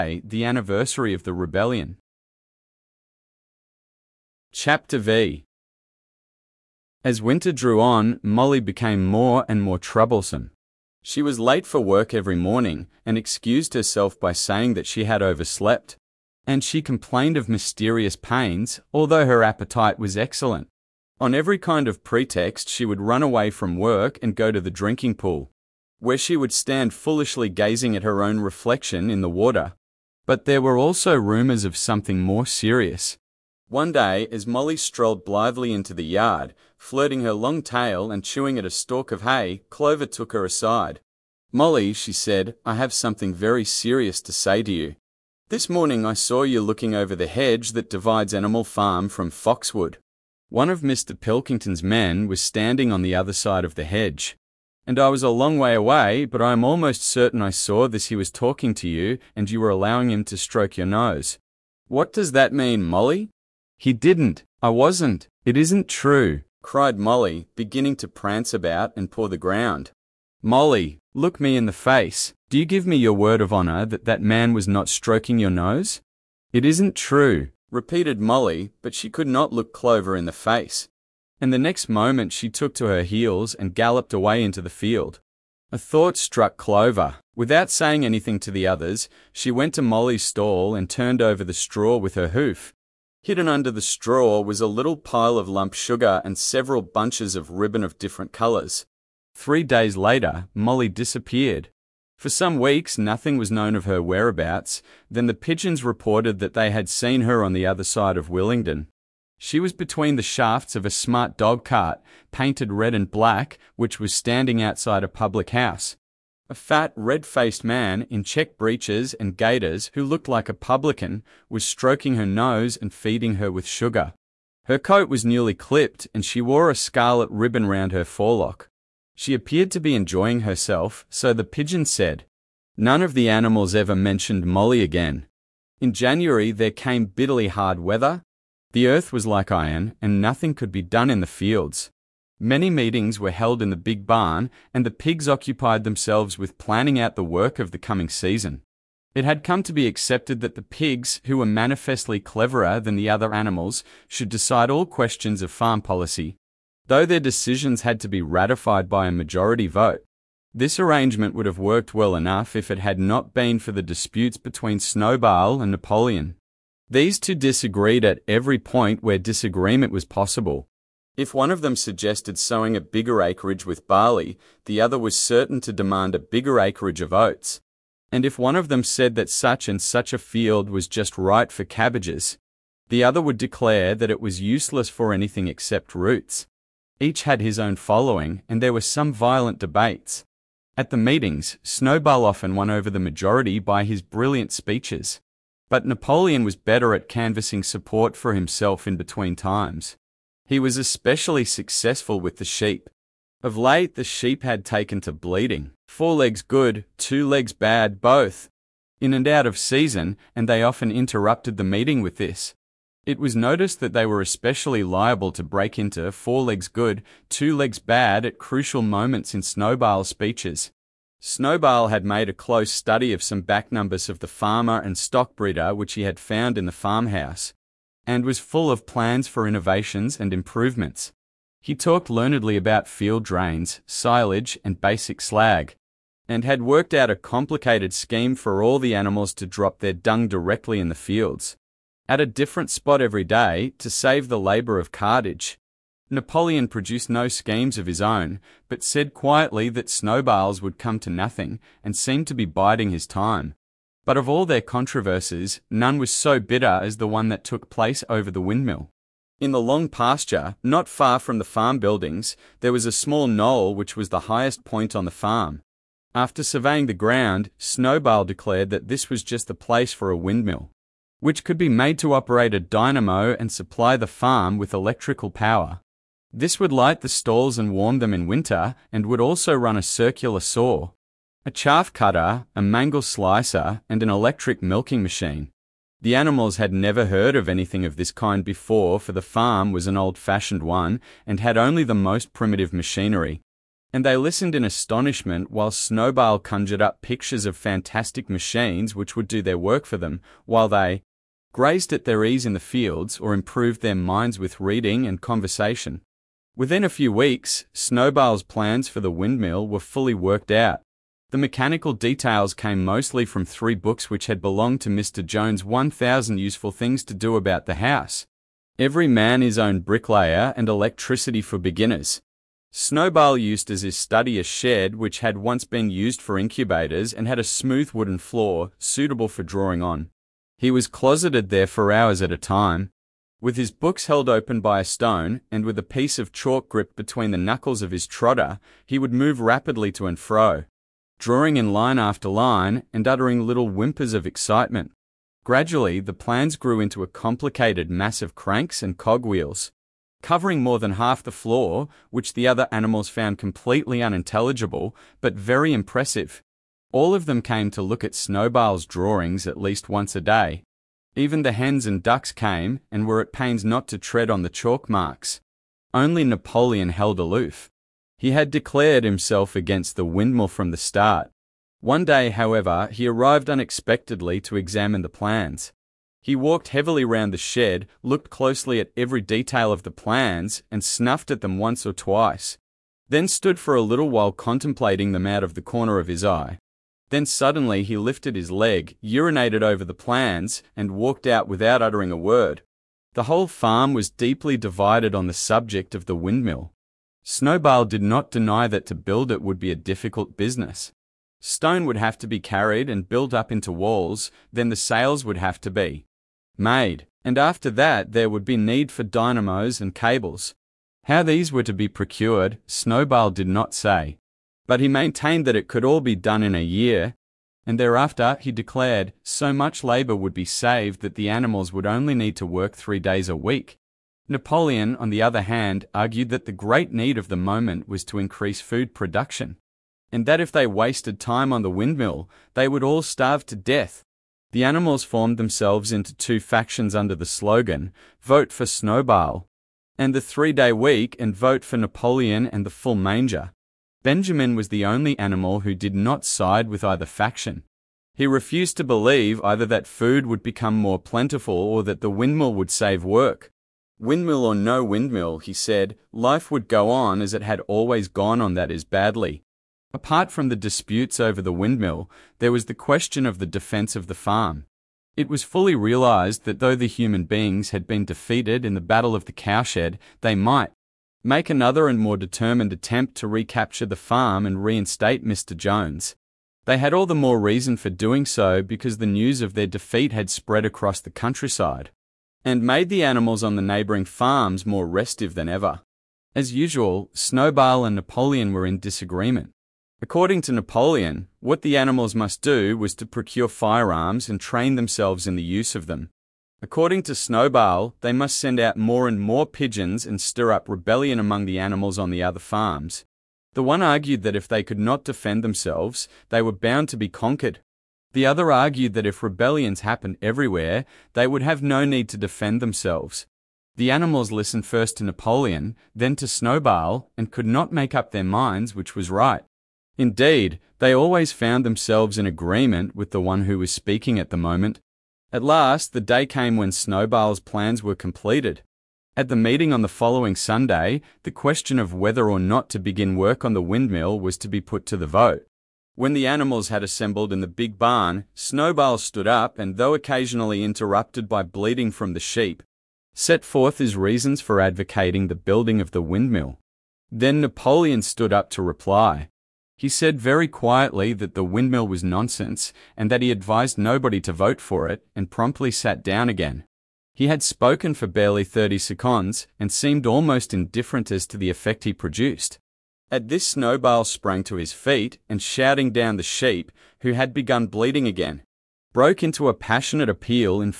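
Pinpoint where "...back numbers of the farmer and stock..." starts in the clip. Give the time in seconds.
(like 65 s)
223 s.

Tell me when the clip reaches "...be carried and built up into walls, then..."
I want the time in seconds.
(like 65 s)
402 s.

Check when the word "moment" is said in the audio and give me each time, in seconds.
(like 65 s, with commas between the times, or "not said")
81 s, 218 s, 427 s, 524 s.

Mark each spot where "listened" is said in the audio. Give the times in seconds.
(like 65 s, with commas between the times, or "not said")
294 s, 514 s.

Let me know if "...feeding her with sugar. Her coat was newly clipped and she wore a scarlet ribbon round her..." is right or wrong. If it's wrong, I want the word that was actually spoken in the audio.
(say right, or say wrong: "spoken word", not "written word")
right.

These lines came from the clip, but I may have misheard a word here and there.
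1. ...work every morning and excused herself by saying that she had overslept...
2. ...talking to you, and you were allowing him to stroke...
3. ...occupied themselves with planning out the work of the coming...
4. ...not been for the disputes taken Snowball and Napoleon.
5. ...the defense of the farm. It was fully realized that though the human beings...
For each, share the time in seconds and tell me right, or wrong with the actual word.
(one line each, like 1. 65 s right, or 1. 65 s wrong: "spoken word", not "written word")
1. 11 s right
2. 58 s right
3. 145 s right
4. 162 s wrong: "between", not "taken"
5. 463 s right.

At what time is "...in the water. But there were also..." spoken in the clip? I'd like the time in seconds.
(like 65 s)
29 s.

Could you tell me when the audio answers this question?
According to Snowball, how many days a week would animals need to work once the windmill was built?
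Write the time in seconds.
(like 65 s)
422 s.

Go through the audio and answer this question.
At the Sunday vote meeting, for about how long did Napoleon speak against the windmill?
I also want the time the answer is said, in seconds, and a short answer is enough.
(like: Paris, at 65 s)
30 seconds, at 558 s.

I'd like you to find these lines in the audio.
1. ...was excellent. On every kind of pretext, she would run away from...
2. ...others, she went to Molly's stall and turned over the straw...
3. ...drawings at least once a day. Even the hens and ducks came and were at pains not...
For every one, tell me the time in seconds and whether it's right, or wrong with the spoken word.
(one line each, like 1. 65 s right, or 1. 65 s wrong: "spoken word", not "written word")
1. 19 s right
2. 88 s right
3. 358 s right.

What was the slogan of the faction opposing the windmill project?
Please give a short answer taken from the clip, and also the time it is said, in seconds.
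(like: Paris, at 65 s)
Vote for Napoleon and the full manger, at 441 s.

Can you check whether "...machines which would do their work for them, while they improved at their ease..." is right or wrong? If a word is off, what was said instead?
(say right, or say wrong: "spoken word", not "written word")
wrong: "grazed", not "improved".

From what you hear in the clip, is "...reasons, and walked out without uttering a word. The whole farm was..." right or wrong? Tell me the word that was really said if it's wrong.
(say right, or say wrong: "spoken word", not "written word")
wrong: "plans", not "reasons".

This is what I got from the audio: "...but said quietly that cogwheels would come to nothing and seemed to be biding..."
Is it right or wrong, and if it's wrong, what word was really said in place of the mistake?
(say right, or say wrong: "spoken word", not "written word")
wrong: "snowballs", not "cogwheels".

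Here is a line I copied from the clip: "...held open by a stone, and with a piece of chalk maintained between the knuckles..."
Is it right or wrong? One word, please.
wrong.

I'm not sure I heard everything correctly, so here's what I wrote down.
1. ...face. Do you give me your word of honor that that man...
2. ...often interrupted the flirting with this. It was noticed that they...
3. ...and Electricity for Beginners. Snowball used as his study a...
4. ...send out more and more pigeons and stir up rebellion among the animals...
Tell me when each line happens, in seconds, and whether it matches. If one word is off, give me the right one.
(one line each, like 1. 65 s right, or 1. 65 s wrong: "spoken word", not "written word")
1. 71 s right
2. 210 s wrong: "meeting", not "flirting"
3. 320 s right
4. 498 s right.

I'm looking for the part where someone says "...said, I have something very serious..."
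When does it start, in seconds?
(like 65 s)
42 s.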